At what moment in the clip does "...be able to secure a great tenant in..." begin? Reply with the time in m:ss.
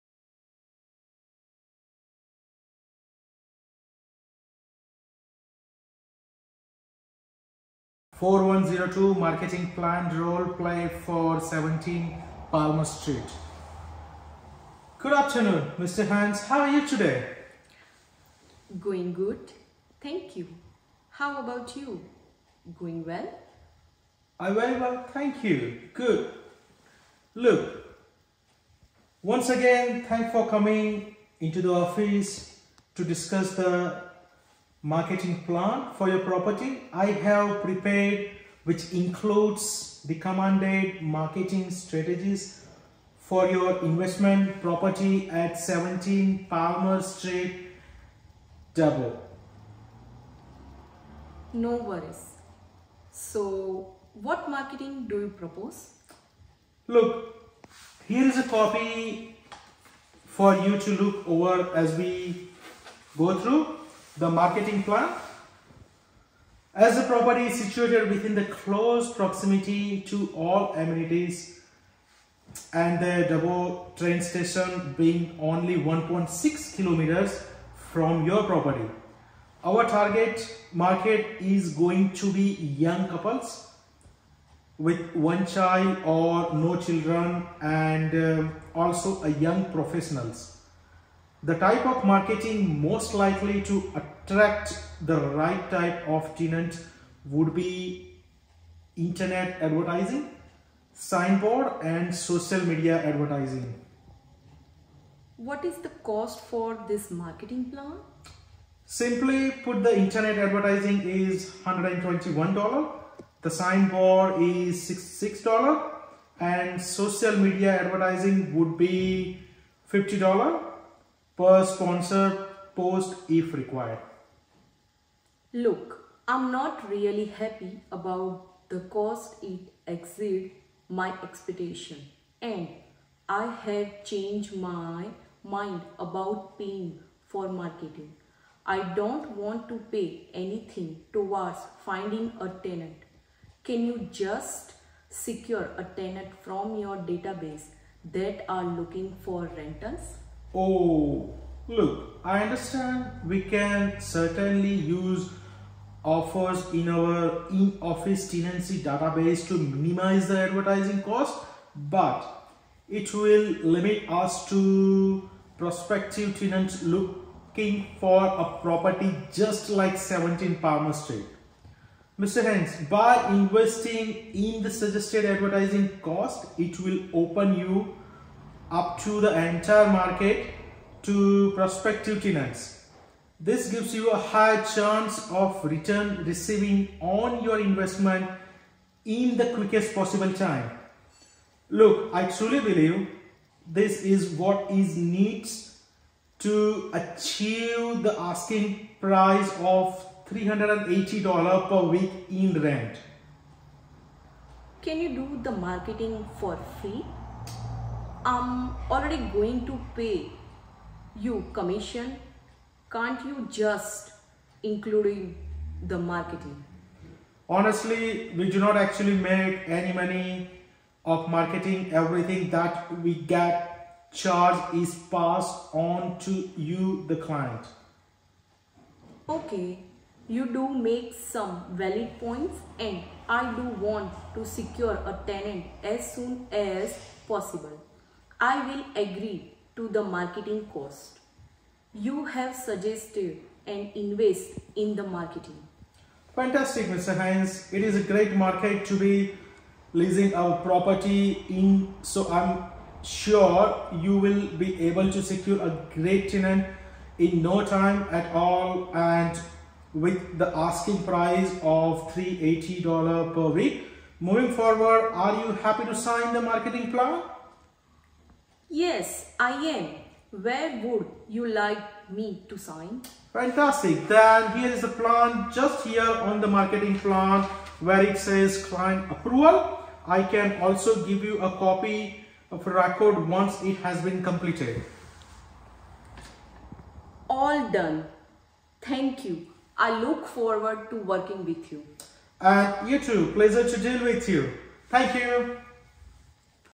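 4:14.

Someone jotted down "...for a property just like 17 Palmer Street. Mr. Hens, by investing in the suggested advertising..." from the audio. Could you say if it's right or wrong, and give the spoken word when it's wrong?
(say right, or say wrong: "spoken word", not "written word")
right.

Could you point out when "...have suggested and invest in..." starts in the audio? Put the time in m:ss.
4:02.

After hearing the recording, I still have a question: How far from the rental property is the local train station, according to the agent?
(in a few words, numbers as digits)
1.6 kilometres.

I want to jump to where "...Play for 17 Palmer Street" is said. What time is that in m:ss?
0:10.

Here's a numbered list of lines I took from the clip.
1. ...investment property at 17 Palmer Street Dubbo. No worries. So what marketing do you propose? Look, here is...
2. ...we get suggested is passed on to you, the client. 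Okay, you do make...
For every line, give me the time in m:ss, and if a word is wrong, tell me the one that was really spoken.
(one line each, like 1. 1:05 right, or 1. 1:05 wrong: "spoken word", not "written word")
1. 0:43 right
2. 3:43 wrong: "charged", not "suggested".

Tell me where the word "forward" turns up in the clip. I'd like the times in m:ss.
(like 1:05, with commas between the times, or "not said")
4:24, 4:50.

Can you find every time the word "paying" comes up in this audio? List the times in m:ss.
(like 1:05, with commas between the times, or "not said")
2:16.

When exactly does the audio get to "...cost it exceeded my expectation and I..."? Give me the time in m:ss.
2:08.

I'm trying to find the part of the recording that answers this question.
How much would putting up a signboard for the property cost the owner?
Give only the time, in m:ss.
1:54.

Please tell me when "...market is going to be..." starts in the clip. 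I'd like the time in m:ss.
1:20.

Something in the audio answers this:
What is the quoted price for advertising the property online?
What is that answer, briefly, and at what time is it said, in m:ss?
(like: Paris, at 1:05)
$121, at 1:51.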